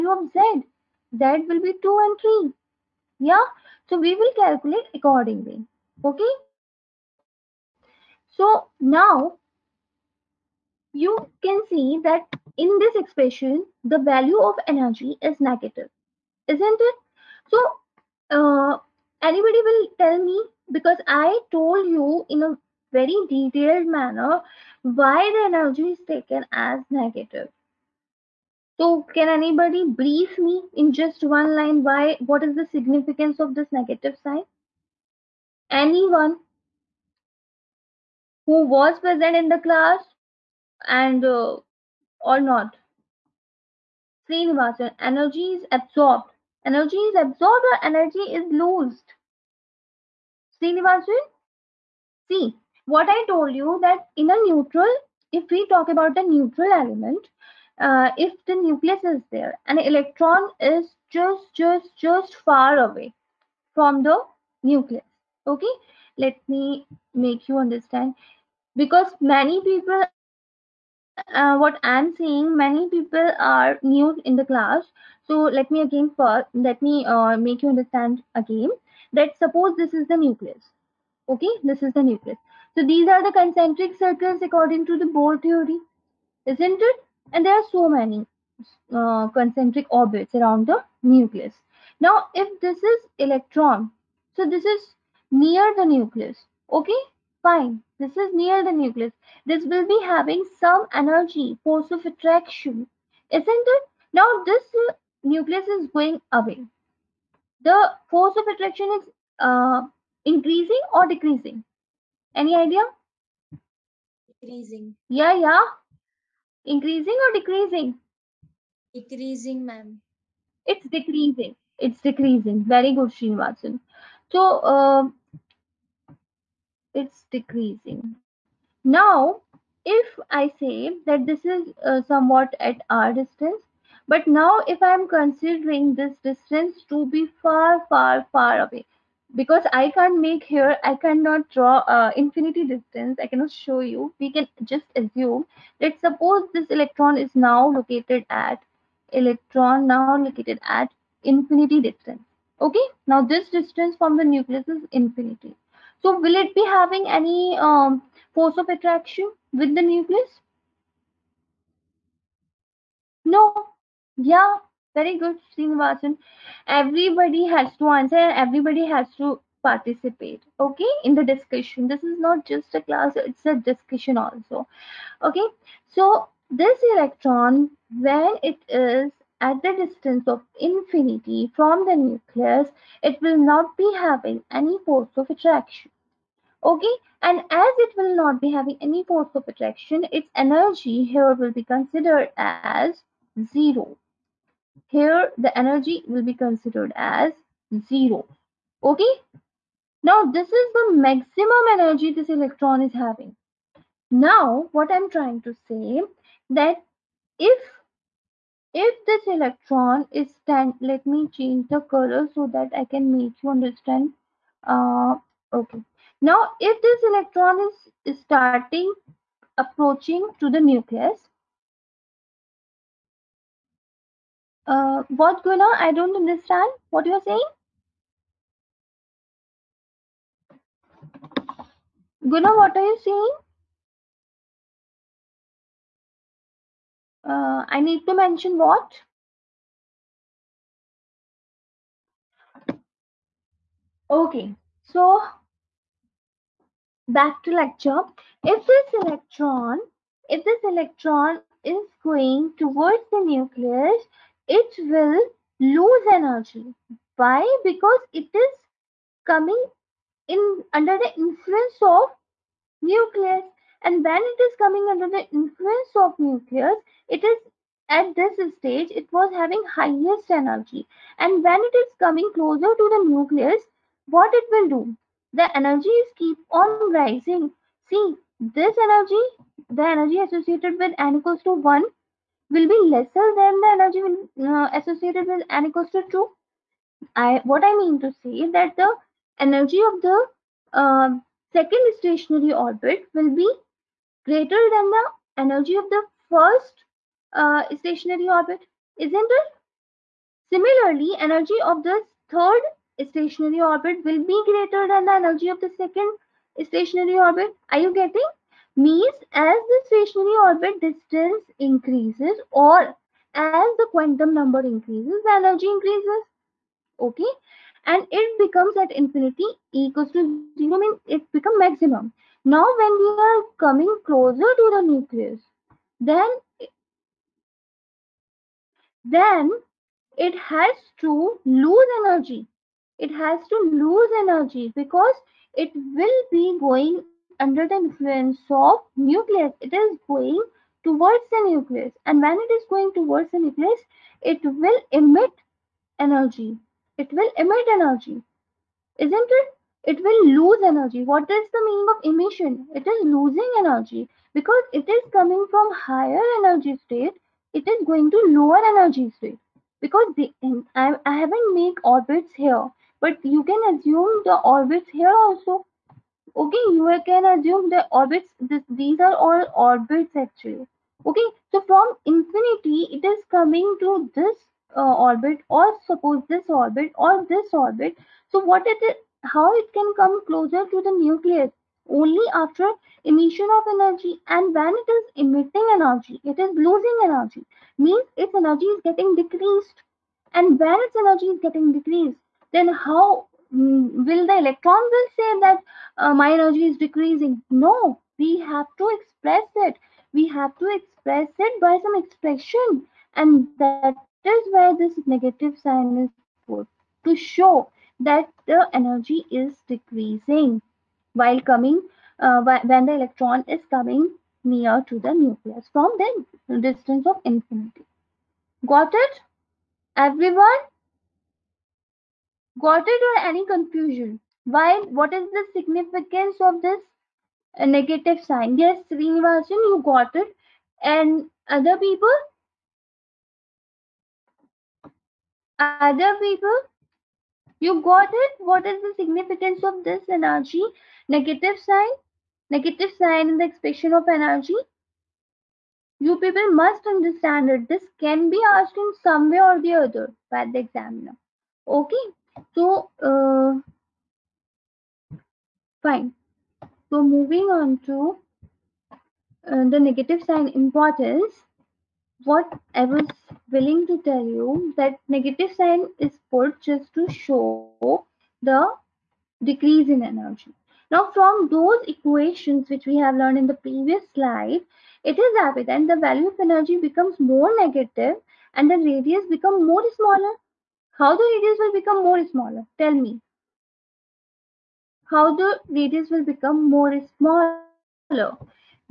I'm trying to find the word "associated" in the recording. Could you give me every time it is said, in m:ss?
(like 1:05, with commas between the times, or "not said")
4:40, 4:44.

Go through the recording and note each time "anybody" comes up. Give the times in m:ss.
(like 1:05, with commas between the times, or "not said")
0:19, 0:29.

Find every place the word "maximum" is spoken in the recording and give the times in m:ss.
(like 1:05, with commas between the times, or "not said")
3:20, 5:21.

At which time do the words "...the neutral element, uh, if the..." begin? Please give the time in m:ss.
0:56.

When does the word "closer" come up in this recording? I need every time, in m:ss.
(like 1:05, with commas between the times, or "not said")
4:32, 5:24, 6:20.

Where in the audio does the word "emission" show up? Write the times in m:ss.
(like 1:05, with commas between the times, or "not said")
5:52, 6:23.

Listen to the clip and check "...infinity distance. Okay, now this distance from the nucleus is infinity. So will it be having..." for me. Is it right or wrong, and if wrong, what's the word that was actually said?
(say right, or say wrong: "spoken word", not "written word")
right.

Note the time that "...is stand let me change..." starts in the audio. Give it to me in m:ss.
3:30.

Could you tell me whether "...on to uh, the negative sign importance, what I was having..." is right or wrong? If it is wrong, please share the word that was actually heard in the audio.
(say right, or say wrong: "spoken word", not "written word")
wrong: "willing", not "having".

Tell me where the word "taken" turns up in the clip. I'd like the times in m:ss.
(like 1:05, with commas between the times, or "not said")
0:26.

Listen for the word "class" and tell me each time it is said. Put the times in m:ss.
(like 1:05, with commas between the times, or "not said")
0:39, 1:14, 2:52.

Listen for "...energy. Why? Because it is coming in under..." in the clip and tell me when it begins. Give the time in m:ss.
4:16.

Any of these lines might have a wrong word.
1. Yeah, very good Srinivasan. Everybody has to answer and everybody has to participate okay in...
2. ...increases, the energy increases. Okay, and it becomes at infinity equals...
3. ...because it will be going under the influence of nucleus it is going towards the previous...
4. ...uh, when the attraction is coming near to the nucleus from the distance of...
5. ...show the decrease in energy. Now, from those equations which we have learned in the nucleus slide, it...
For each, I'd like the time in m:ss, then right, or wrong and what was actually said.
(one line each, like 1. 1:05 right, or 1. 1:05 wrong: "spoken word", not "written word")
1. 2:44 right
2. 5:14 right
3. 5:34 wrong: "nucleus", not "previous"
4. 6:52 wrong: "electron", not "attraction"
5. 7:47 wrong: "previous", not "nucleus".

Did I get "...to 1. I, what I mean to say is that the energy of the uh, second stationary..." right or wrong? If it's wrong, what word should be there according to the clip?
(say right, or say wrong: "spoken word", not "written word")
wrong: "2", not "1".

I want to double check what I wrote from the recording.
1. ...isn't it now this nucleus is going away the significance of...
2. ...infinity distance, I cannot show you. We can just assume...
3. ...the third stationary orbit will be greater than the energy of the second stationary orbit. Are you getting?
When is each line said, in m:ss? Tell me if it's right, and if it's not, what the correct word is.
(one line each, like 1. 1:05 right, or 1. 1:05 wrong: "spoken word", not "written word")
1. 1:43 wrong: "force", not "significance"
2. 2:22 right
3. 5:01 right.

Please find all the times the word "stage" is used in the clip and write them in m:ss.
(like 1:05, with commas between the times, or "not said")
4:28.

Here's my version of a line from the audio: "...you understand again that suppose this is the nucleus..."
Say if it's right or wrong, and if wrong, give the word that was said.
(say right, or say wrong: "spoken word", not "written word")
right.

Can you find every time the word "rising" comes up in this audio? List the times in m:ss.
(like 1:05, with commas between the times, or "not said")
4:36.